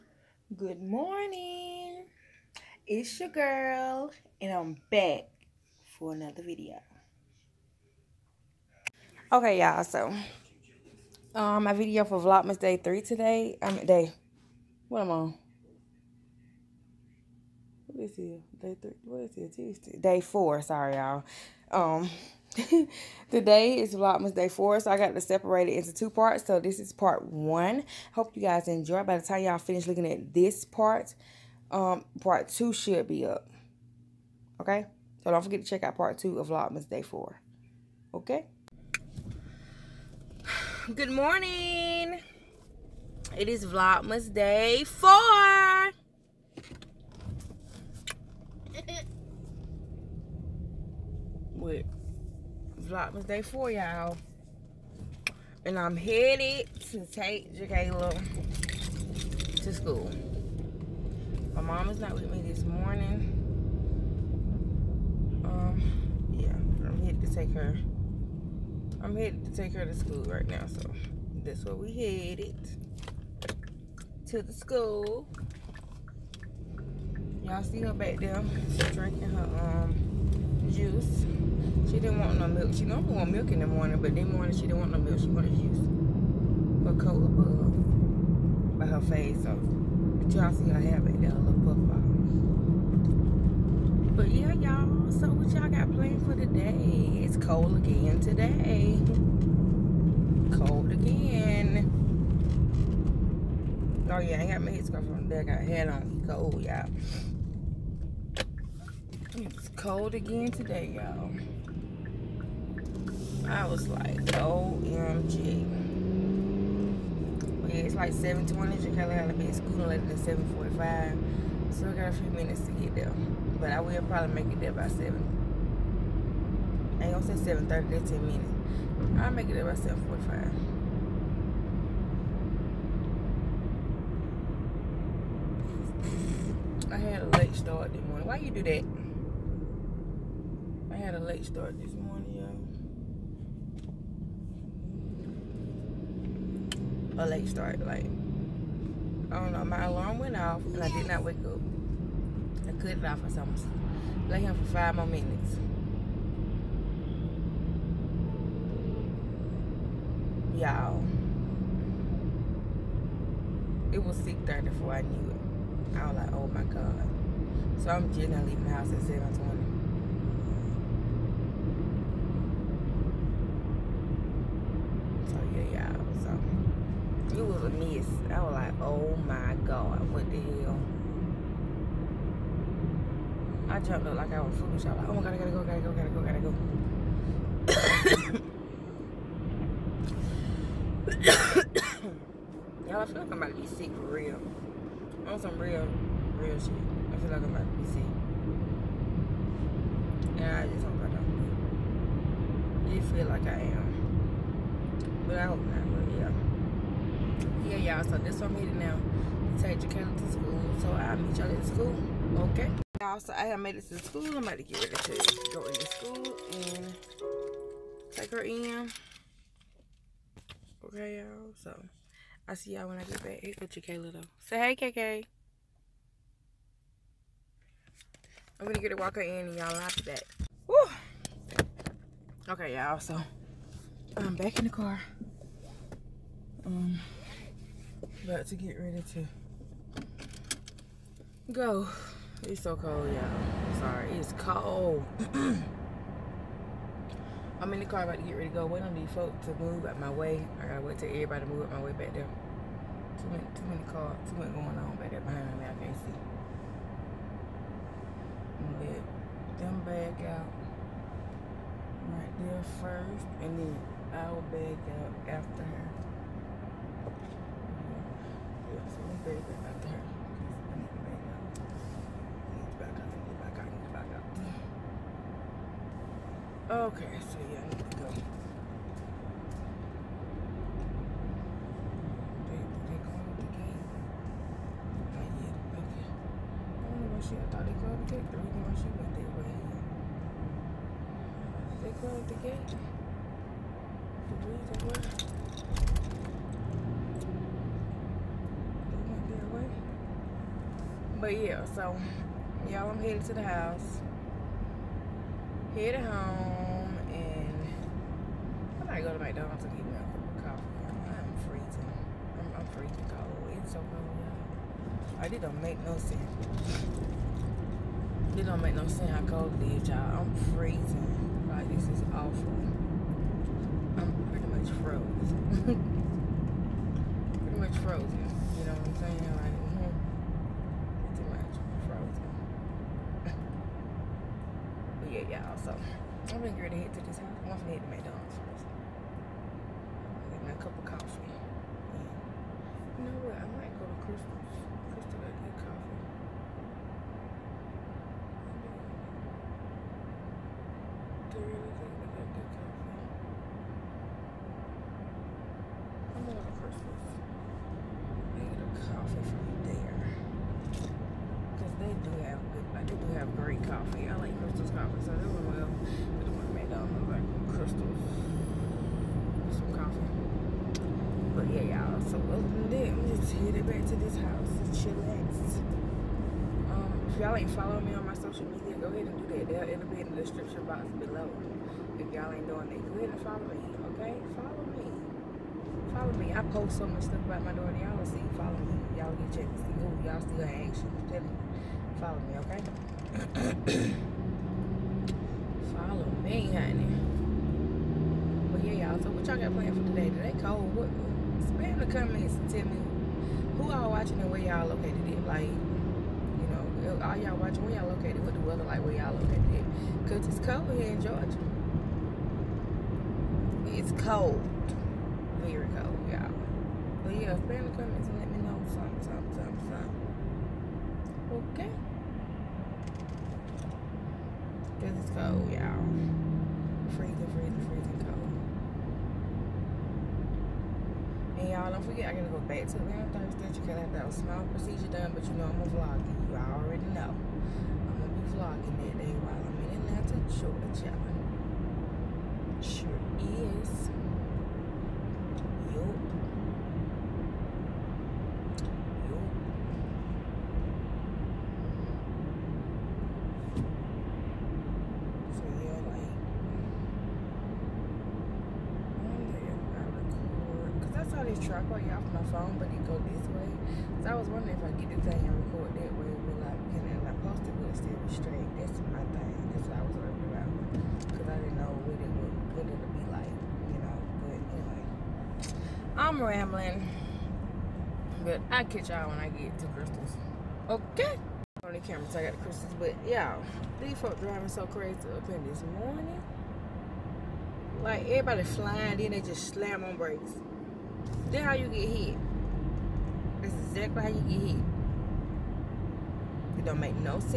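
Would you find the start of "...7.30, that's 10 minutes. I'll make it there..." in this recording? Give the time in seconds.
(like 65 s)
127 s.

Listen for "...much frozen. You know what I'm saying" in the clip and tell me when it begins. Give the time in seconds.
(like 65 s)
327 s.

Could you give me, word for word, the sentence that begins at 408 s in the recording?
What the weather like, where y'all located It, Because it's cold here in Georgia.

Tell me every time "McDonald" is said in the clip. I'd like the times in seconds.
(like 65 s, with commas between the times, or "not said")
309 s, 337 s.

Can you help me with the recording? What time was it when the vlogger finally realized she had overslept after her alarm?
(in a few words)
6:30.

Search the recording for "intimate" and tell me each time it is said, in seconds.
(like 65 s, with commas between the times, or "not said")
not said.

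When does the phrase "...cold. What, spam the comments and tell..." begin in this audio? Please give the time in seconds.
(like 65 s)
400 s.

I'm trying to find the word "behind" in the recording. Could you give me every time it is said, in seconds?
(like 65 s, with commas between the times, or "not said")
255 s.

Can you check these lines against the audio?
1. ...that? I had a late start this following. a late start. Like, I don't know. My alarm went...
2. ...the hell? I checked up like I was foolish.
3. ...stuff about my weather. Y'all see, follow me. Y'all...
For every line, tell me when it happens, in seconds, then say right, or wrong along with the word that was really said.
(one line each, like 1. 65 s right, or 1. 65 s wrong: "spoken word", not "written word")
1. 138 s wrong: "morning", not "following"
2. 180 s wrong: "jumped", not "checked"
3. 387 s wrong: "daughter", not "weather".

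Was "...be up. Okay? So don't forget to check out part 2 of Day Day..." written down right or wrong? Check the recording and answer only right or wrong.
wrong.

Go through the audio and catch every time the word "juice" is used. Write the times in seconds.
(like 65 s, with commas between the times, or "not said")
80 s, 85 s.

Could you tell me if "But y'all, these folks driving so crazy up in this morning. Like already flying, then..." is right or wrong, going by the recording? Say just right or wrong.
wrong.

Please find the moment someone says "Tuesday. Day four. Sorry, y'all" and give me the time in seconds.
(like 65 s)
19 s.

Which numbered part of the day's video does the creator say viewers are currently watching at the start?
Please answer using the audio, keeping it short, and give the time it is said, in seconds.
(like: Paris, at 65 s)
Part 1, at 26 s.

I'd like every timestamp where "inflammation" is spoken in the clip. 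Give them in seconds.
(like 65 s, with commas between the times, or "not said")
not said.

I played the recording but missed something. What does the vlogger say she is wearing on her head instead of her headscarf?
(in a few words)
A hat.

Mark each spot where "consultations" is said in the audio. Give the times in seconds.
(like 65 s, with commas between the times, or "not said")
not said.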